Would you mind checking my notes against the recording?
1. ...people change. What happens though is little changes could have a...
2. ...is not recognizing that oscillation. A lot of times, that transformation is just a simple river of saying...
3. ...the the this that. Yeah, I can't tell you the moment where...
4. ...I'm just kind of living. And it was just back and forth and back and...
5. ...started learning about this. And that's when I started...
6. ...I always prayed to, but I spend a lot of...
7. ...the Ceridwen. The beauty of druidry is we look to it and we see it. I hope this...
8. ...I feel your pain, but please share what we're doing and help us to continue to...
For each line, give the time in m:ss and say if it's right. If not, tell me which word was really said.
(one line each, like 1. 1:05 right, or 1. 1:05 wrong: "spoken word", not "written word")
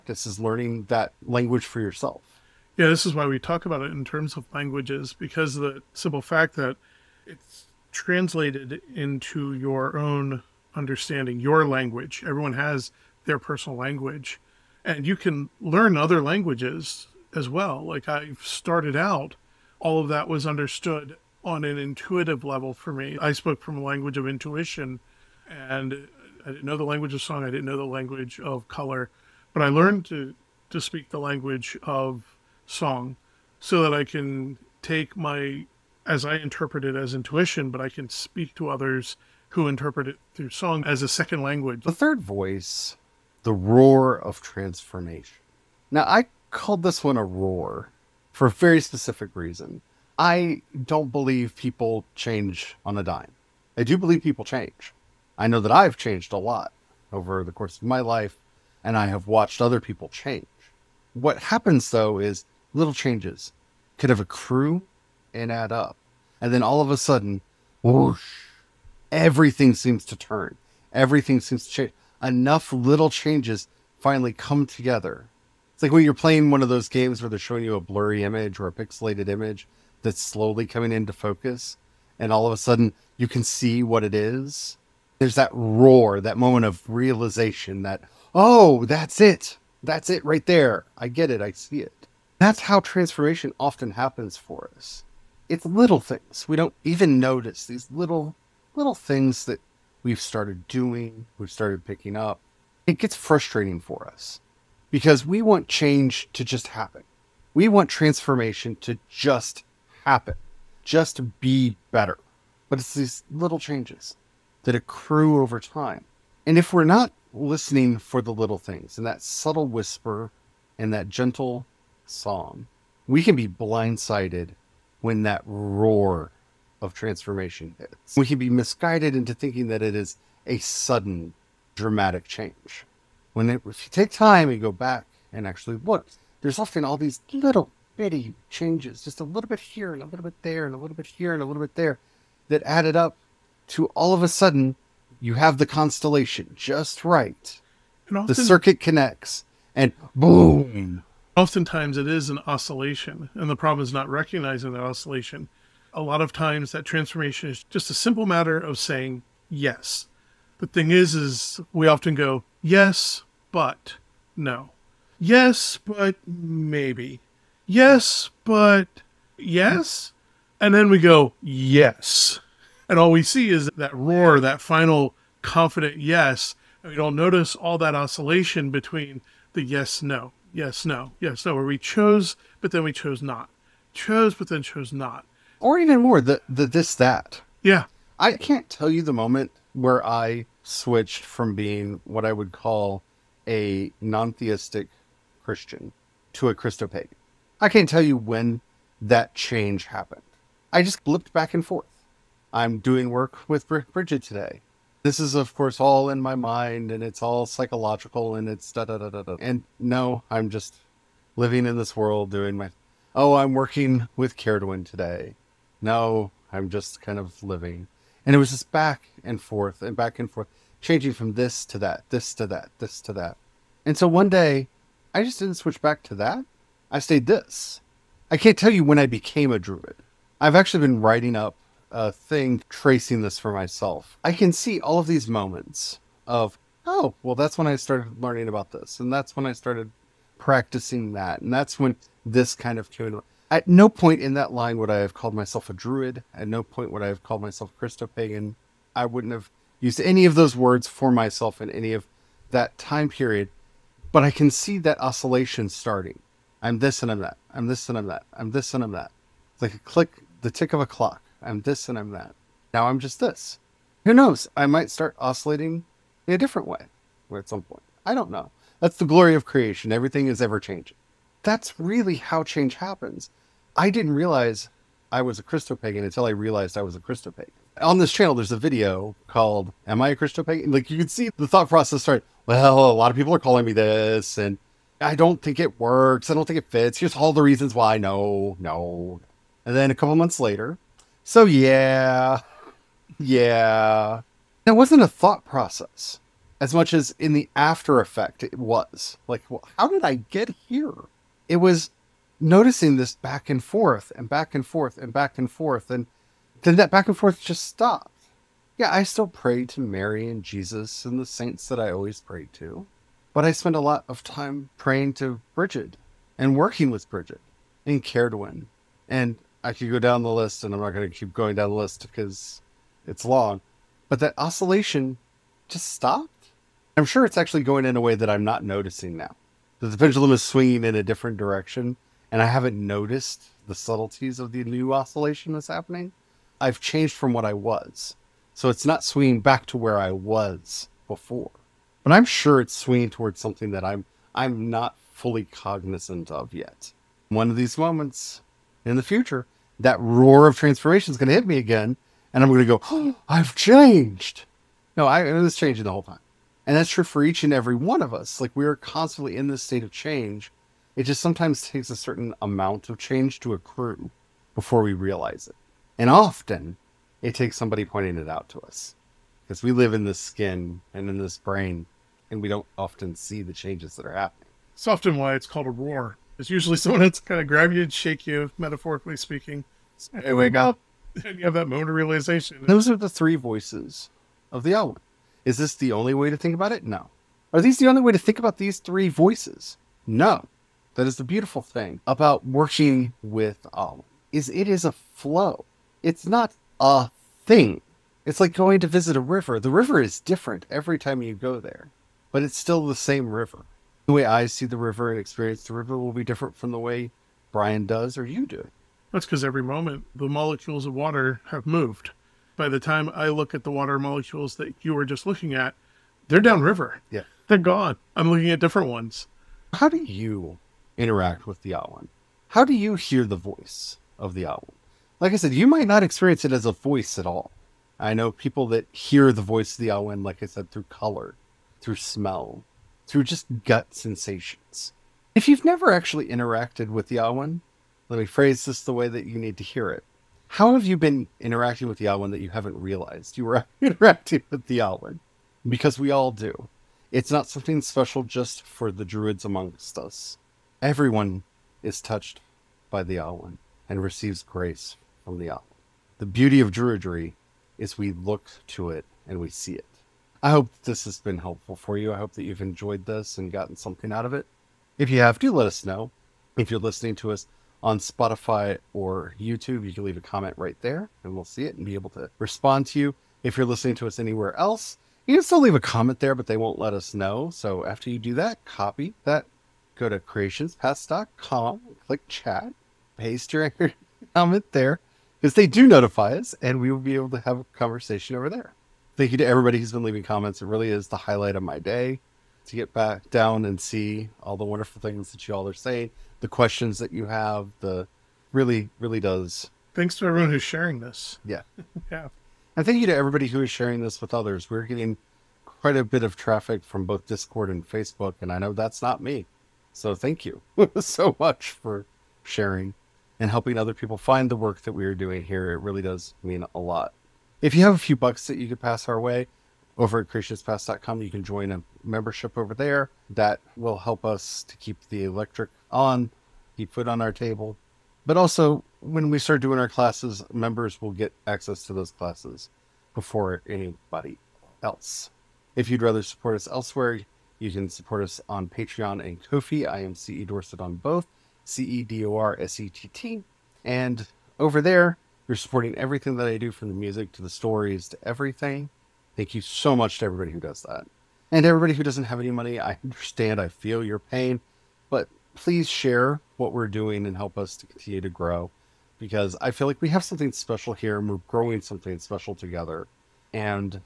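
1. 0:59 right
2. 2:33 wrong: "matter", not "river"
3. 3:06 right
4. 3:36 right
5. 3:57 right
6. 5:11 right
7. 7:35 wrong: "Yawan", not "Ceridwen"
8. 9:13 right.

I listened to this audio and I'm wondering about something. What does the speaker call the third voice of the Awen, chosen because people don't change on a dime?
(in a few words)
The roar of transformation.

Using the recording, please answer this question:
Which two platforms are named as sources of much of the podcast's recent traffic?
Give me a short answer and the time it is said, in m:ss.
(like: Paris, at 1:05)
Discord and Facebook, at 8:27.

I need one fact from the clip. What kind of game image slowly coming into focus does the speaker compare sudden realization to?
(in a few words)
Pixelated image.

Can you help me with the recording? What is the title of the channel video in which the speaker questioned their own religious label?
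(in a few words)
Am I a pagan?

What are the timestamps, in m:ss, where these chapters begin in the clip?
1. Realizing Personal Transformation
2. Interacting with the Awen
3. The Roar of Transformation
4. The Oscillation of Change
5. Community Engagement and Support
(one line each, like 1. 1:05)
1. 4:32
2. 6:21
3. 0:42
4. 2:30
5. 7:39.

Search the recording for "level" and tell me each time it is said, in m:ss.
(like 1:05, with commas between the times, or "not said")
0:22.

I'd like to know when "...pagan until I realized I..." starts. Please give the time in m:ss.
4:35.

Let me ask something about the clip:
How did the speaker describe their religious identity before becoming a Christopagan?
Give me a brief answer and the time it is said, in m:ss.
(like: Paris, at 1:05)
Non-theistic Christian, at 3:14.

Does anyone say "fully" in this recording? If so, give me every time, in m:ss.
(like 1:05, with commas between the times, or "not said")
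5:45.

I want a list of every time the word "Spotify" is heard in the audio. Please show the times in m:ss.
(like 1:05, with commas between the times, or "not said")
7:47.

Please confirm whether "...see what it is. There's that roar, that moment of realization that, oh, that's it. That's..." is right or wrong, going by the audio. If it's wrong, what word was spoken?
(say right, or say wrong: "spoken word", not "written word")
right.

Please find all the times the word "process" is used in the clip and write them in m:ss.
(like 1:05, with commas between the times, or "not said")
4:41, 4:55.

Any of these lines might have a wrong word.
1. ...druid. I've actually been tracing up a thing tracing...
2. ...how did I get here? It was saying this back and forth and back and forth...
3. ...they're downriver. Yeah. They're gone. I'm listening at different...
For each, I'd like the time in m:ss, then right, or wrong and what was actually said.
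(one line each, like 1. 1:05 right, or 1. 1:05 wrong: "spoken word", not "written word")
1. 3:49 wrong: "writing", not "tracing"
2. 4:59 wrong: "noticing", not "saying"
3. 6:56 wrong: "looking", not "listening".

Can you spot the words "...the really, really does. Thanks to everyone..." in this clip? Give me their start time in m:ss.
8:17.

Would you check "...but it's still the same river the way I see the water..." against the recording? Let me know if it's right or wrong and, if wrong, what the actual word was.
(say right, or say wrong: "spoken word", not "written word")
wrong: "river", not "water".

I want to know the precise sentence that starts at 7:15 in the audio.
If you've never actually interacted with Yawan, let me phrase this the way that you need to hear it.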